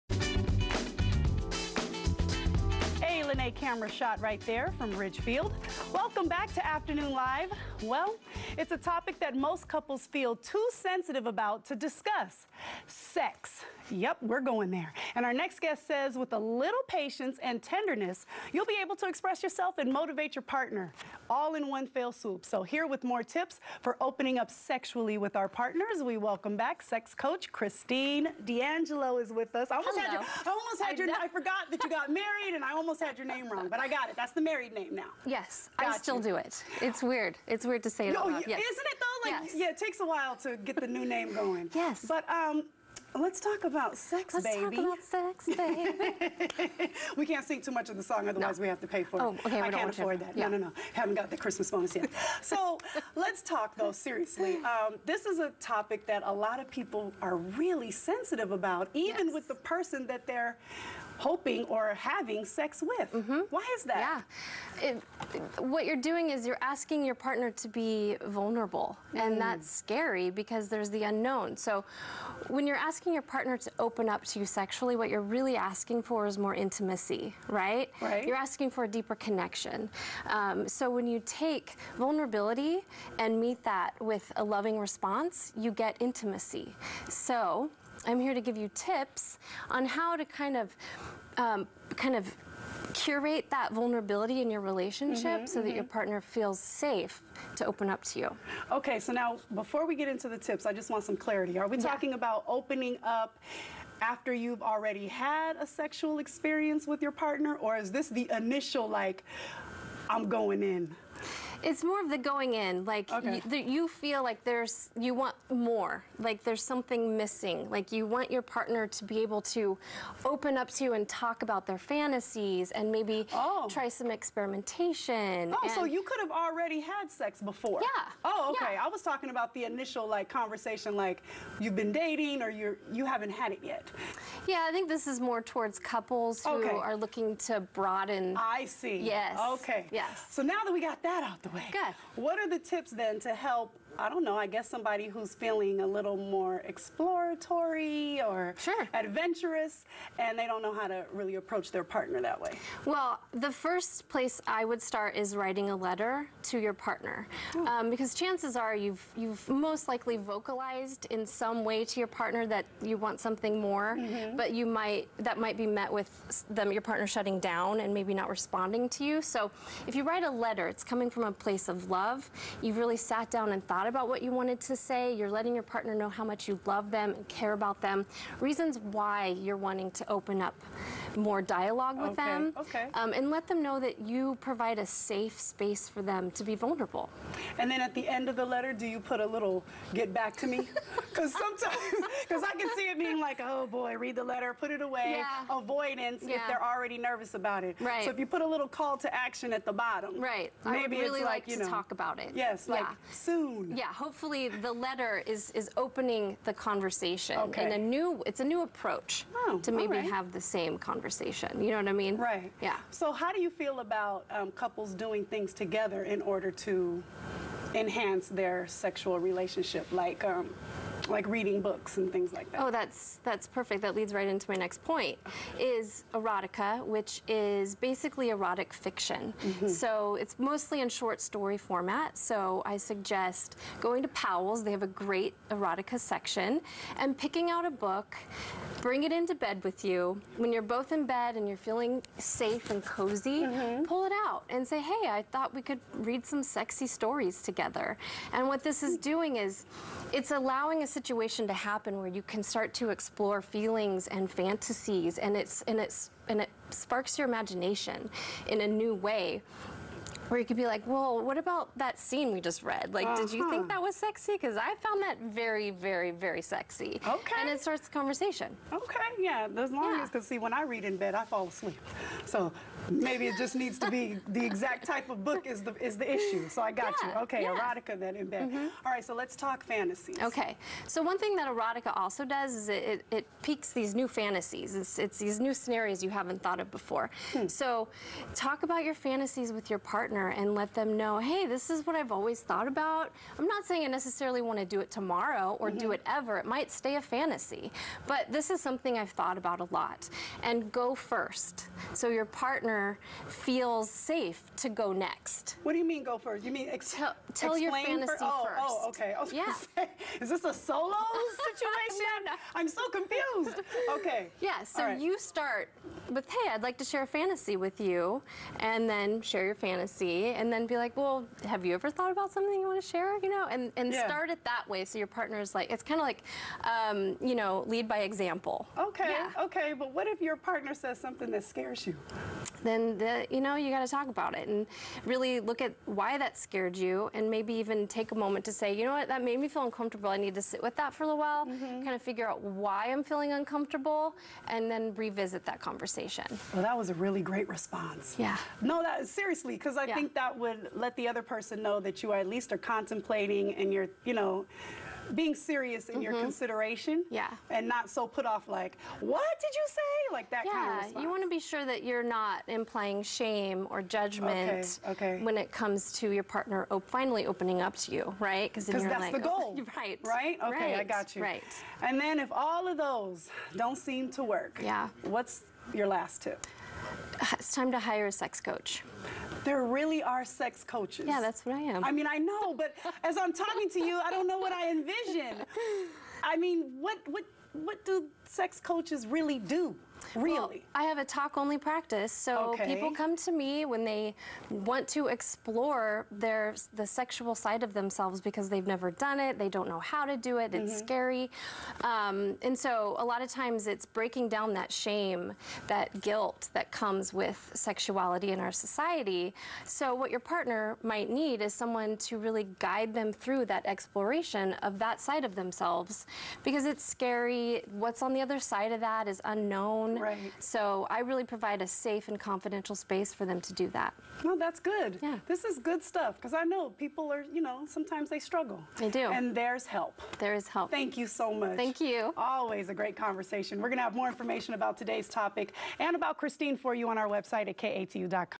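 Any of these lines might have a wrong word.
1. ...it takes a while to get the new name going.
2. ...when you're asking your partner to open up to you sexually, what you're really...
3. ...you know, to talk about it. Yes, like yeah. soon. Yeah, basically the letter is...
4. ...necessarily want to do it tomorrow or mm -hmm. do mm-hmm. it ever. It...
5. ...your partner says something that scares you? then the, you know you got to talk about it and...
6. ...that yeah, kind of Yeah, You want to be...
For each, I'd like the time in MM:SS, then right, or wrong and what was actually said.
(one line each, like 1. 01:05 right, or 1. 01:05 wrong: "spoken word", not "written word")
1. 00:39 right
2. 01:12 right
3. 03:21 wrong: "hopefully", not "basically"
4. 04:53 right
5. 05:30 right
6. 06:00 right.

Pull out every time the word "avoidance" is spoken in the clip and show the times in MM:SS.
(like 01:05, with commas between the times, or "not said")
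03:15.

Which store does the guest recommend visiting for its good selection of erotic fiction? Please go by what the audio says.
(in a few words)
Powell's.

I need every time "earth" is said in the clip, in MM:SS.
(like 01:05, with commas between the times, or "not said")
not said.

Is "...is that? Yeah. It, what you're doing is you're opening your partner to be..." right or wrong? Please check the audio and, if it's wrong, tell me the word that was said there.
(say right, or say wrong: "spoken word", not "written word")
wrong: "asking", not "opening".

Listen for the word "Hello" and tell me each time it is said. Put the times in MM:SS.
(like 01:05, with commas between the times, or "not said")
00:29.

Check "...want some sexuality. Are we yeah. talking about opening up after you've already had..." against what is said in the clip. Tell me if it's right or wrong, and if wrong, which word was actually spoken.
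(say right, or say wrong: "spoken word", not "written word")
wrong: "clarity", not "sexuality".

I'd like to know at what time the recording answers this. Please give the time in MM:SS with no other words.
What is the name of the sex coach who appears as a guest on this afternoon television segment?
00:27.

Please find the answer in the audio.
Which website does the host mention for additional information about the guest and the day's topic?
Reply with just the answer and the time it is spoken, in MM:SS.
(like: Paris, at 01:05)
katu.com, at 07:17.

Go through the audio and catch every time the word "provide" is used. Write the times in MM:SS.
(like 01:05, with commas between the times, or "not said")
03:04, 07:01.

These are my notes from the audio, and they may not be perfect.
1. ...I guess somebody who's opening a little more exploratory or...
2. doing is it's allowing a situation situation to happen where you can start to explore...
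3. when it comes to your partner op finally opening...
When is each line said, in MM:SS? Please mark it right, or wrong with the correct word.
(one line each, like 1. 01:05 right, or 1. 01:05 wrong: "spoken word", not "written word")
1. 02:24 wrong: "feeling", not "opening"
2. 04:09 right
3. 06:05 right.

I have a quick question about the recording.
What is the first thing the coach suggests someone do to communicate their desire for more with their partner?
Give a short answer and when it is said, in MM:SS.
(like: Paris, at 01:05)
Write a letter, at 02:35.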